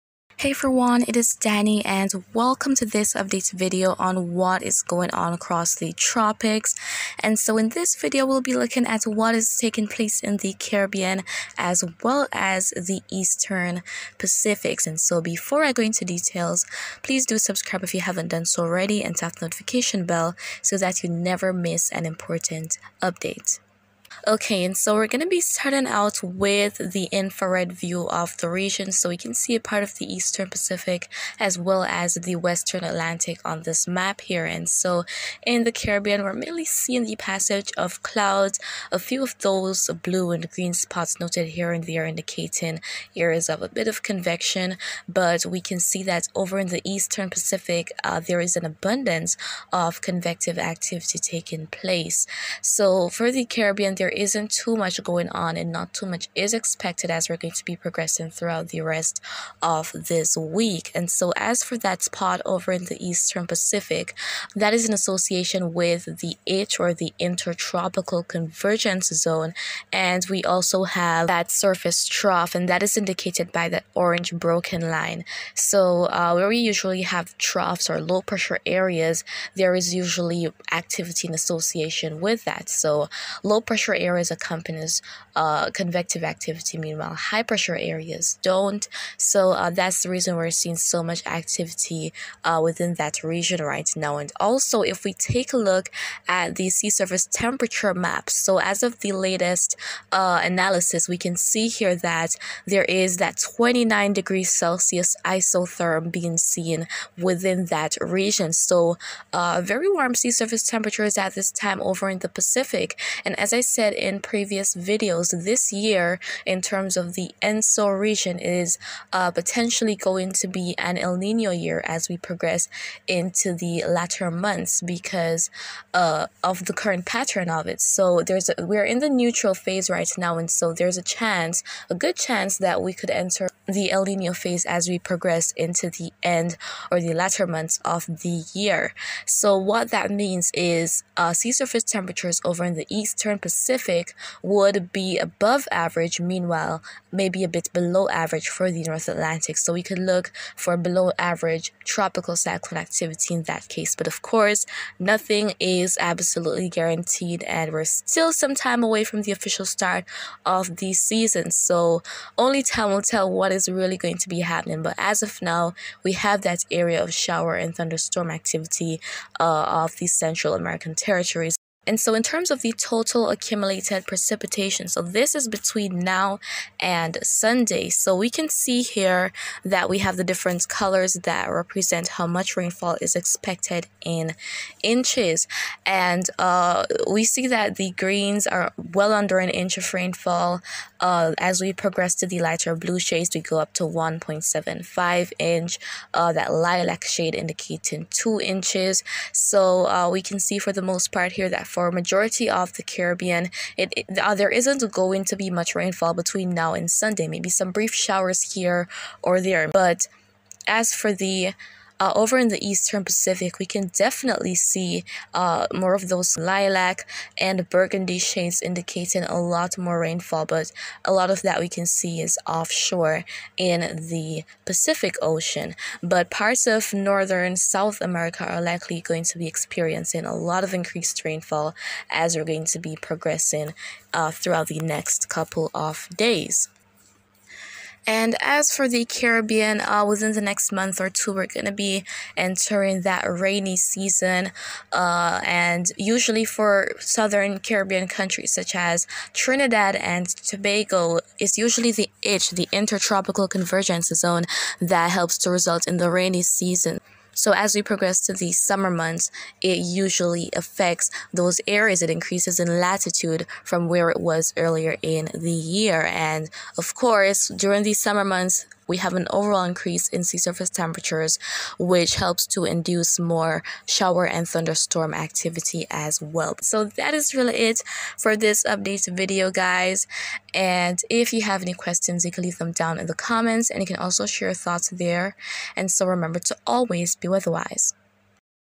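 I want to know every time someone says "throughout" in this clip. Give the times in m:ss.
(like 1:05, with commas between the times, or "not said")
0:58, 3:54.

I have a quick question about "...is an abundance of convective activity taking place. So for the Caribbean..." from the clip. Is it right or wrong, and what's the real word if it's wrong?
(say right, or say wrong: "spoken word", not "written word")
right.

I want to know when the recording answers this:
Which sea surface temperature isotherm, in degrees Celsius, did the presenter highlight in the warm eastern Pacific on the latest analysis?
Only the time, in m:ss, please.
1:43.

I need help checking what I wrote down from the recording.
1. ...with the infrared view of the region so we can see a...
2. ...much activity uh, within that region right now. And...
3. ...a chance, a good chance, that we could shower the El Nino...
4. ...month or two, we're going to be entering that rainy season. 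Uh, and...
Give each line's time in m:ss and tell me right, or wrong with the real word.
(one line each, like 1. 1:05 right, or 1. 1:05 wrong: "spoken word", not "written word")
1. 0:26 right
2. 1:31 right
3. 2:10 wrong: "enter", not "shower"
4. 4:00 right.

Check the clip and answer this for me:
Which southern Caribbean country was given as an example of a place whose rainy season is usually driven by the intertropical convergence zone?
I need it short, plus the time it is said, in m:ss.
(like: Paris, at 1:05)
Trinidad and Tobago, at 4:09.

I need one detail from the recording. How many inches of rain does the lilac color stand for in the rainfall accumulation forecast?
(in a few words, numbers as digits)
2 inches.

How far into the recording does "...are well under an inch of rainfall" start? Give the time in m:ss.
3:08.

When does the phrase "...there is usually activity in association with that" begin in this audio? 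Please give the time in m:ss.
1:19.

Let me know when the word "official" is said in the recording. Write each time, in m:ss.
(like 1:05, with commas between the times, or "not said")
2:39.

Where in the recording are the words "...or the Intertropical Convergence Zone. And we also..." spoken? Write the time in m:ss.
1:06.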